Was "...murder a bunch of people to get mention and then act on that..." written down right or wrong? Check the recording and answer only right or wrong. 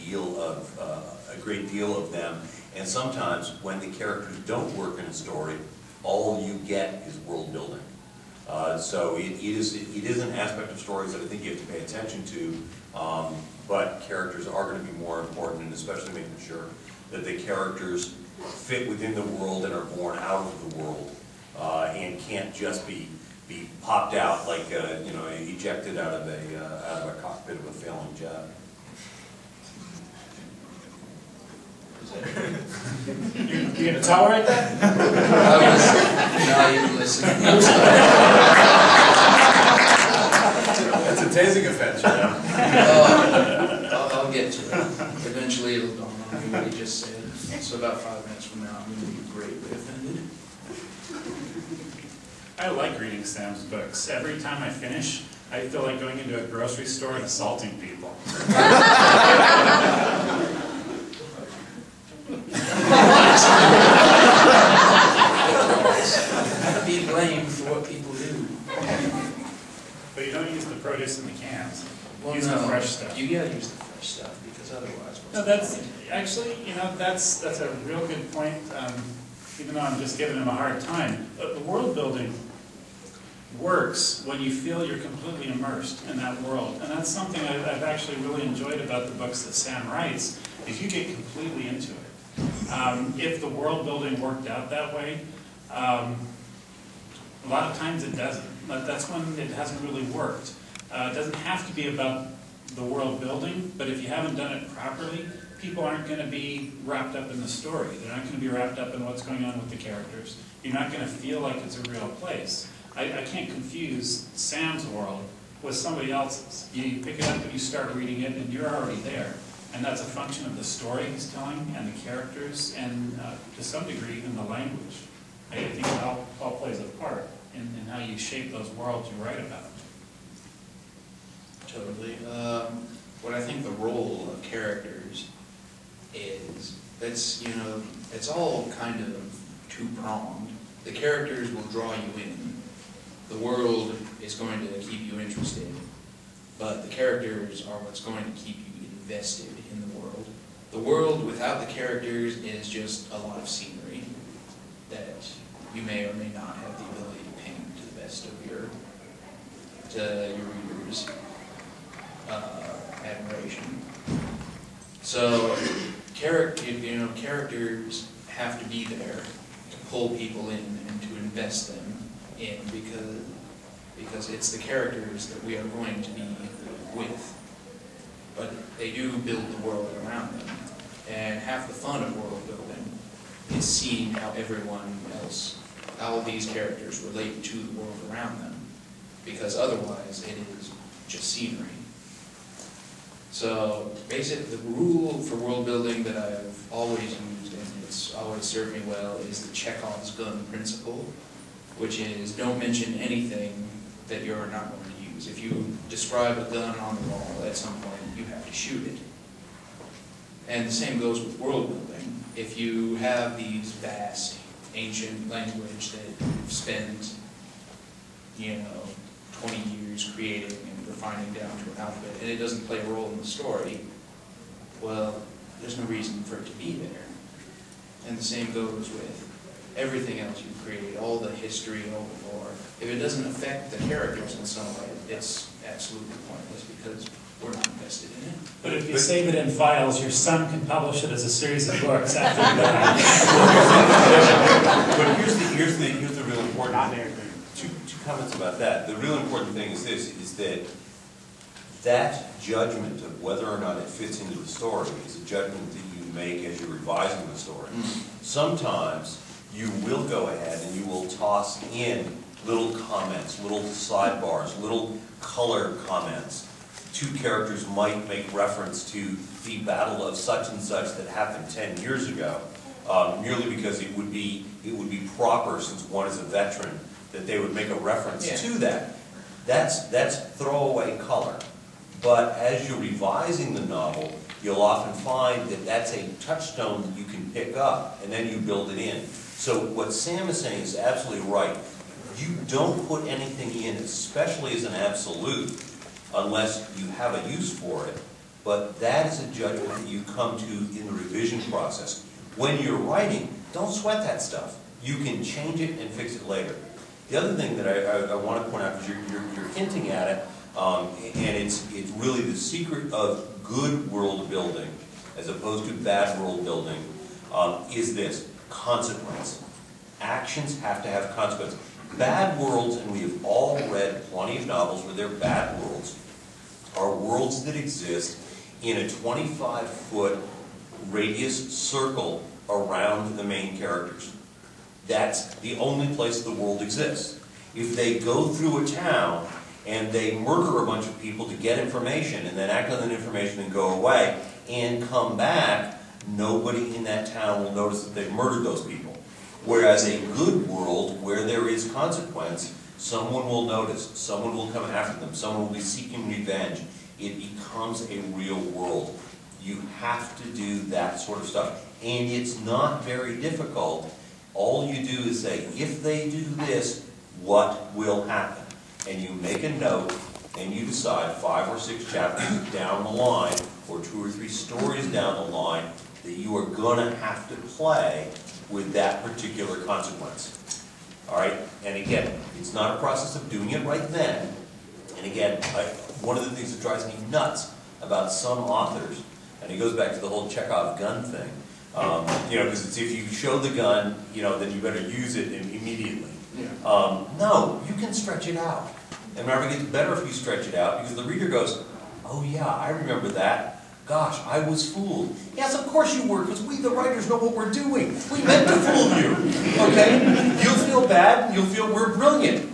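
wrong.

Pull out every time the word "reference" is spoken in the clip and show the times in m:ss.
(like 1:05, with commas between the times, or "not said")
4:28, 4:37.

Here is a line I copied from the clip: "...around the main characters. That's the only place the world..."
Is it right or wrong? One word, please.
right.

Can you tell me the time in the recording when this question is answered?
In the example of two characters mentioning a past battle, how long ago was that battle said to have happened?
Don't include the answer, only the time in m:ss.
4:31.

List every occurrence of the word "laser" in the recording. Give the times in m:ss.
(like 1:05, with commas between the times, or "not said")
not said.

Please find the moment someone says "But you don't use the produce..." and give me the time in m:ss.
1:10.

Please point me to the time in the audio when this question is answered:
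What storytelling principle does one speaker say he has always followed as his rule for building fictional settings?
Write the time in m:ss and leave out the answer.
3:19.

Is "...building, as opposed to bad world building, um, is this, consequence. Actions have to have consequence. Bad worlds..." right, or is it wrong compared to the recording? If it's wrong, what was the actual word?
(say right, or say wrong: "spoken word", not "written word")
right.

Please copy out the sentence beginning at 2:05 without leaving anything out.
I, I think it all, all plays a part in, in how you shape those worlds you write about totally.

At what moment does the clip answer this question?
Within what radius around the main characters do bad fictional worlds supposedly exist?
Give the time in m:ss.
5:28.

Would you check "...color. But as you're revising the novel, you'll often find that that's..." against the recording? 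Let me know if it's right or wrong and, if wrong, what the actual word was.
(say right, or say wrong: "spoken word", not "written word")
right.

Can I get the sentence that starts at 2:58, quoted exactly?
But they do build the world around them.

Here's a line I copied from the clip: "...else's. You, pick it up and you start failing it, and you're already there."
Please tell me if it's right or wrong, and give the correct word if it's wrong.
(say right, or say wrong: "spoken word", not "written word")
wrong: "reading", not "failing".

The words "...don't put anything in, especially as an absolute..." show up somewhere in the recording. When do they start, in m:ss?
4:52.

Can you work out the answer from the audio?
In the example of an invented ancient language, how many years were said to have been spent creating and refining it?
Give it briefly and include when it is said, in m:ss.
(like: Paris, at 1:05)
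20, at 3:39.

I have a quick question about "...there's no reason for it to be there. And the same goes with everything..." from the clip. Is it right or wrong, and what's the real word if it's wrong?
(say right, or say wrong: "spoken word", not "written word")
right.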